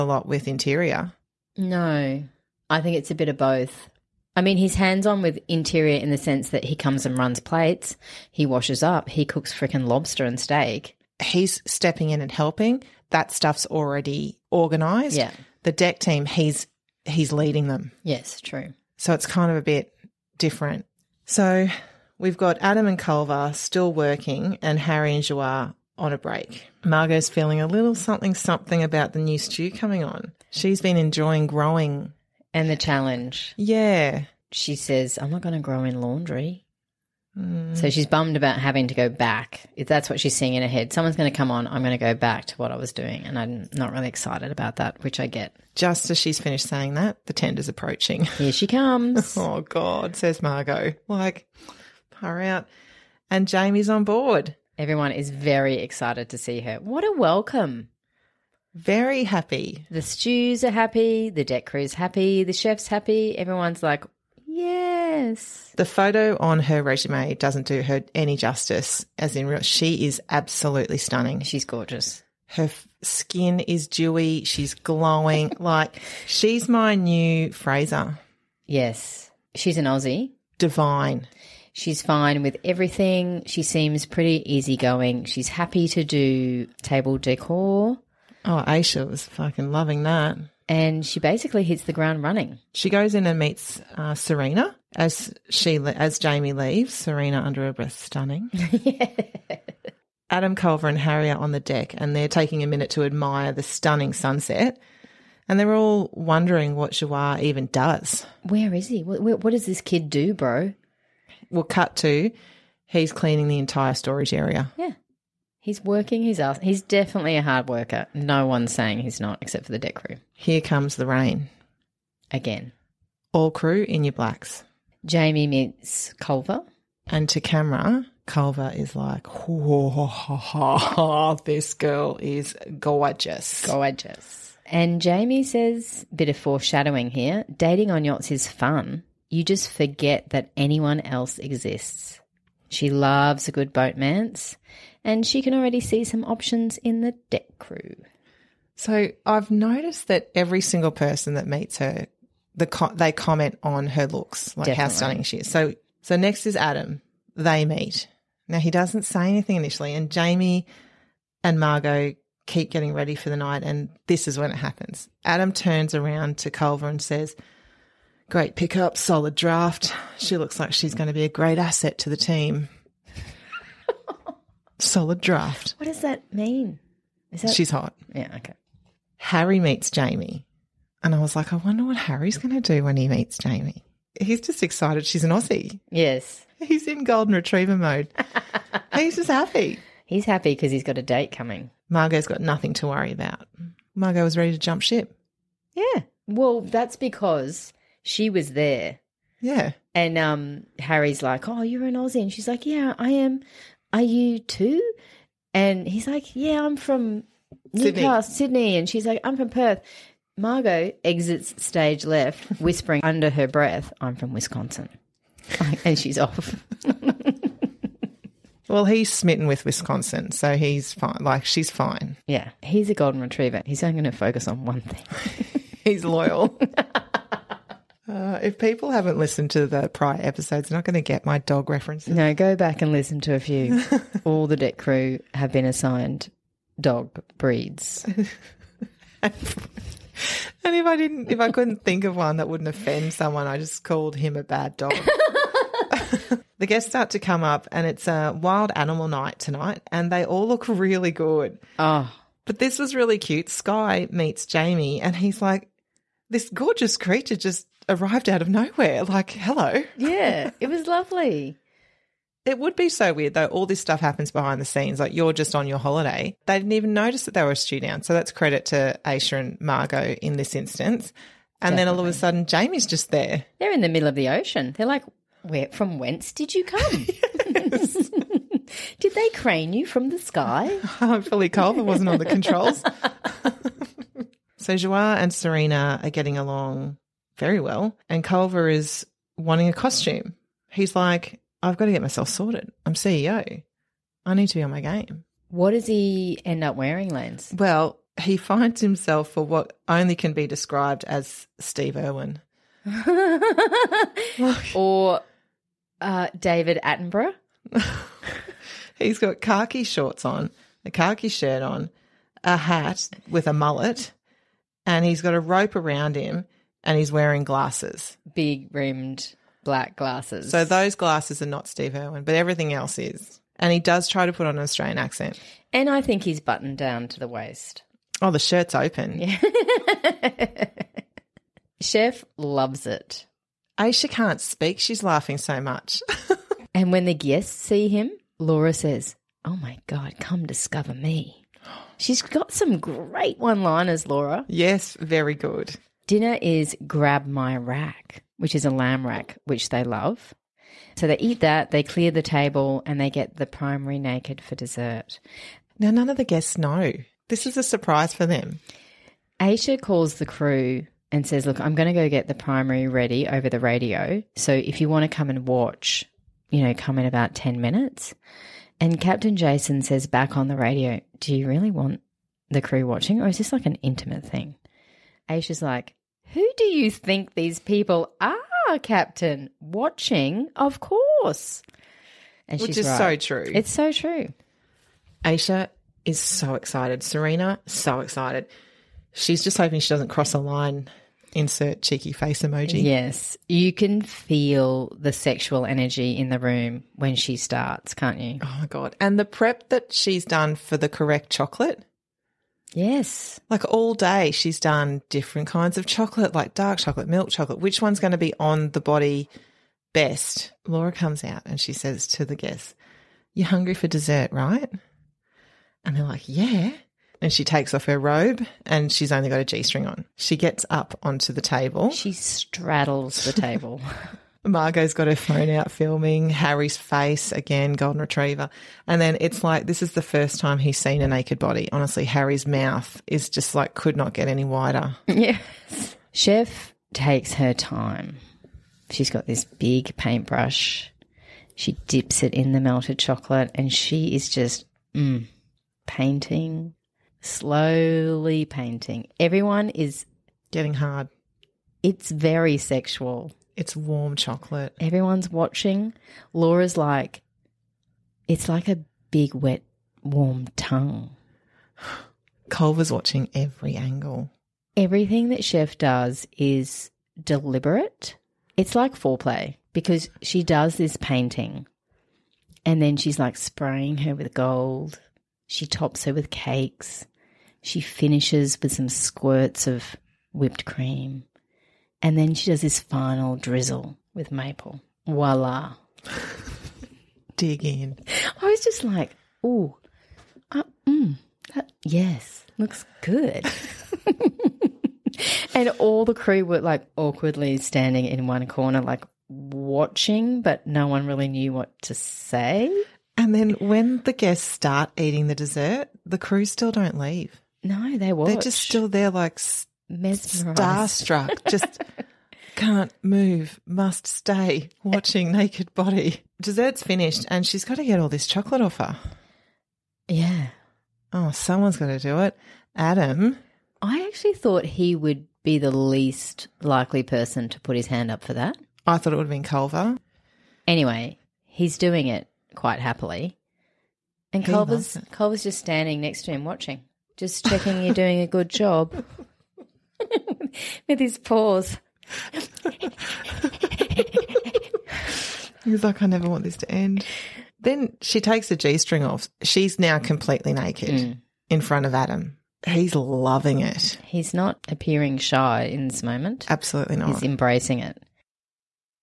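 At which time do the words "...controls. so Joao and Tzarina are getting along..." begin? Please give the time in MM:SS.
04:42.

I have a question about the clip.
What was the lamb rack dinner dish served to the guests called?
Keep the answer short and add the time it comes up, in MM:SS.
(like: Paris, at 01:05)
Grab my rack, at 05:46.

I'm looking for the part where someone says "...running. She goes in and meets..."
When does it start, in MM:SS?
01:32.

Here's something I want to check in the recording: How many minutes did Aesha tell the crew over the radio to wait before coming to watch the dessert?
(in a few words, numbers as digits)
10.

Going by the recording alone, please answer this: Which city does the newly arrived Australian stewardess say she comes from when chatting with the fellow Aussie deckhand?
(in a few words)
Perth.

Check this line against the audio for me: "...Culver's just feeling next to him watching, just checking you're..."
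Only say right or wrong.
wrong.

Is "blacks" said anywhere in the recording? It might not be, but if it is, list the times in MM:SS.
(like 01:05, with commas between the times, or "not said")
02:04, 05:19.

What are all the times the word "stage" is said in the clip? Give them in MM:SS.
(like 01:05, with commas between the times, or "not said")
03:31.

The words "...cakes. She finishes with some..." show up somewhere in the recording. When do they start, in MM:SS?
07:56.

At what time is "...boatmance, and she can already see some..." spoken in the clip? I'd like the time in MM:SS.
02:23.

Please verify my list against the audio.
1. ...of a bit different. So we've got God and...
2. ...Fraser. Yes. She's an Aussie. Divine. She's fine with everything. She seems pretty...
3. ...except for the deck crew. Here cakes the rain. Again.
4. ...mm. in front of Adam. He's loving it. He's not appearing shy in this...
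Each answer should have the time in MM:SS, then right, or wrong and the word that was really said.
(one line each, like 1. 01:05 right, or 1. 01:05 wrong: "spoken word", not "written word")
1. 00:19 wrong: "Adam", not "God"
2. 01:17 right
3. 01:59 wrong: "comes", not "cakes"
4. 09:10 right.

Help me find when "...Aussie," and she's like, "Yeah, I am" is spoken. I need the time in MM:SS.
03:21.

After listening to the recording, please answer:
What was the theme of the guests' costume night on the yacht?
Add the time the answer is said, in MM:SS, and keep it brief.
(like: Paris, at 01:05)
Wild animal, at 04:08.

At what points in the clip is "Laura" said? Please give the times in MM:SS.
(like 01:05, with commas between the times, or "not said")
05:38, 05:44, 06:50, 07:36.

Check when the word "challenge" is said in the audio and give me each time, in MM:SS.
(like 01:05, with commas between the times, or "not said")
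00:32.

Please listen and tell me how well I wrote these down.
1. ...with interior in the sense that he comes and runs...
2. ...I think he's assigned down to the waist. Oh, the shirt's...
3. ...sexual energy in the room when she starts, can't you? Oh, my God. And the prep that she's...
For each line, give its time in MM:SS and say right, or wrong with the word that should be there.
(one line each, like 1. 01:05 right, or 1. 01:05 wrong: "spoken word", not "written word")
1. 00:05 right
2. 05:25 wrong: "buttoned", not "assigned"
3. 06:35 right.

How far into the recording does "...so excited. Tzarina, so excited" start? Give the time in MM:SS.
06:26.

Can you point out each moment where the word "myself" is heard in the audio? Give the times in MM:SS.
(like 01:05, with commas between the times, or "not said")
04:52.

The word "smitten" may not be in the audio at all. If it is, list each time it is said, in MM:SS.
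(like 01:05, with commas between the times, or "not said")
03:39.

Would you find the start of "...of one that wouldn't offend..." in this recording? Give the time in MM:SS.
04:02.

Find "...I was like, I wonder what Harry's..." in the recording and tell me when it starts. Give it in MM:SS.
03:01.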